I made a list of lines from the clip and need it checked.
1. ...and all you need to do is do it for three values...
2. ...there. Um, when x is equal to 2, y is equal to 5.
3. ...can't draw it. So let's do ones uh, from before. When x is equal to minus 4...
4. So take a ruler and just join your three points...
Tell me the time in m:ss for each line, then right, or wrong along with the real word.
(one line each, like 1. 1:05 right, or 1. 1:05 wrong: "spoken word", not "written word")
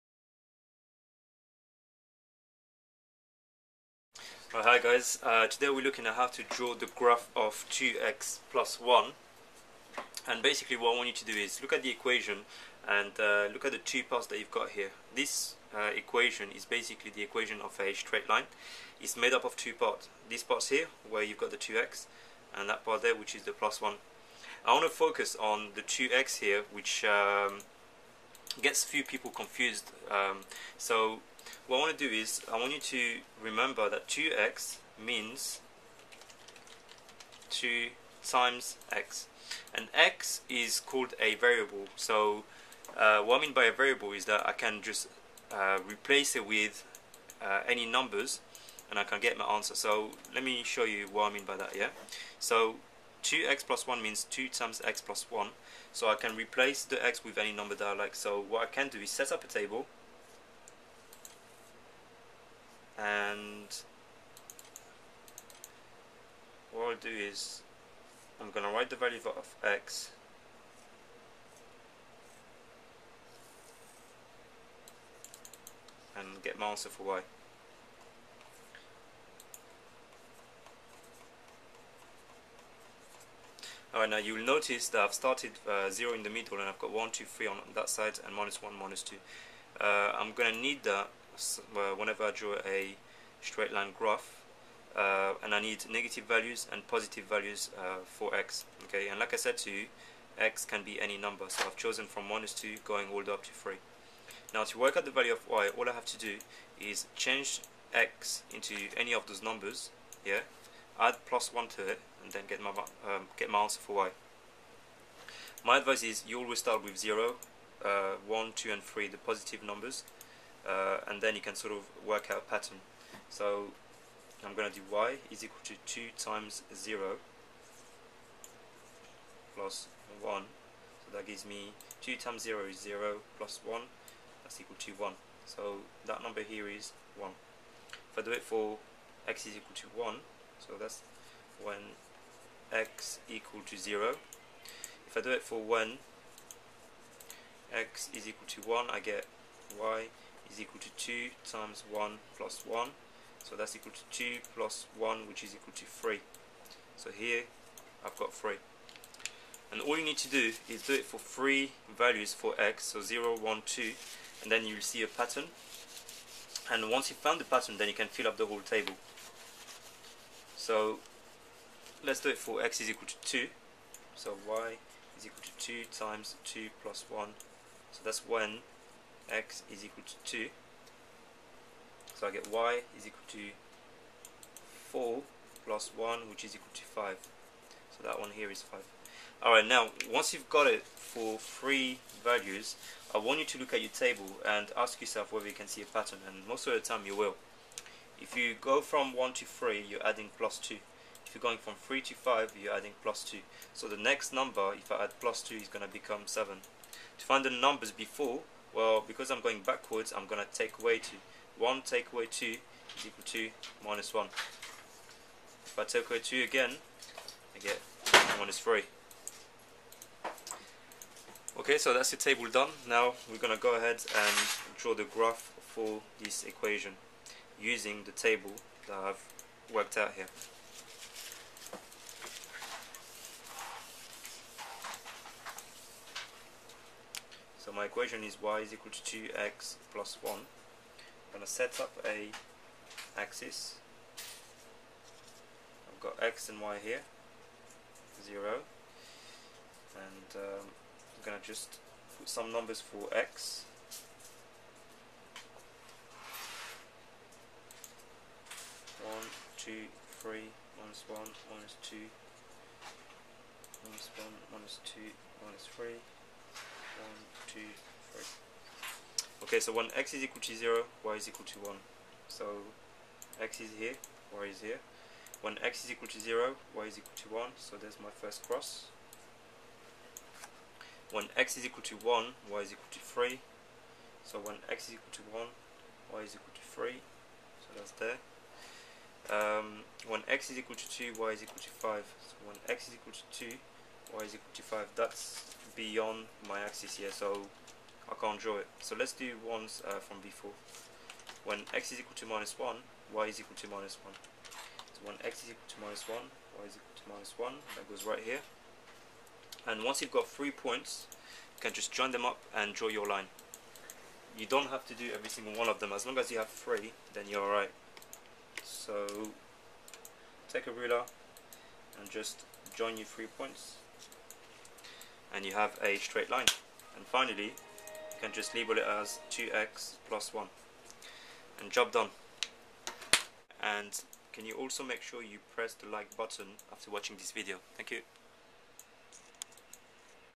1. 2:39 right
2. 4:47 right
3. 4:58 wrong: "1", not "4"
4. 5:18 right.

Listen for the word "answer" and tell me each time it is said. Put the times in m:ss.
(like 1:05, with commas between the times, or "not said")
0:49, 1:16, 1:53.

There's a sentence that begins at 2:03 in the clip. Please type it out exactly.
So I'm going to do y is equal to 2 times 0 plus 1.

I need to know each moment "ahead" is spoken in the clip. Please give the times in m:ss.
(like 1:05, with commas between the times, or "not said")
3:43.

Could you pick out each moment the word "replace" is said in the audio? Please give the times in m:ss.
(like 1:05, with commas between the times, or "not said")
0:45, 0:56.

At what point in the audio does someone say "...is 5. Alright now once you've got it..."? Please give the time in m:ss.
3:08.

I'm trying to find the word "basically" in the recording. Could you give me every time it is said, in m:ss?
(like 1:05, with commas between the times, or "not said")
0:10, 0:16.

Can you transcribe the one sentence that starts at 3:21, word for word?
If you're going from 3 to 5 you're adding plus 2.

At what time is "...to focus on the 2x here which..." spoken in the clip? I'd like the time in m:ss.
0:24.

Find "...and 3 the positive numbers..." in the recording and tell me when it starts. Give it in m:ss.
1:58.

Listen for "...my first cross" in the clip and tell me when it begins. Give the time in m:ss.
4:38.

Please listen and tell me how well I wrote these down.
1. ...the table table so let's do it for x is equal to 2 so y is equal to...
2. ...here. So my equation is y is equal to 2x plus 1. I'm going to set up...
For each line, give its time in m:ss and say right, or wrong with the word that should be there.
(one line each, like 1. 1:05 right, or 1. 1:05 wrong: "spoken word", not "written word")
1. 2:48 wrong: "whole", not "table"
2. 3:50 right.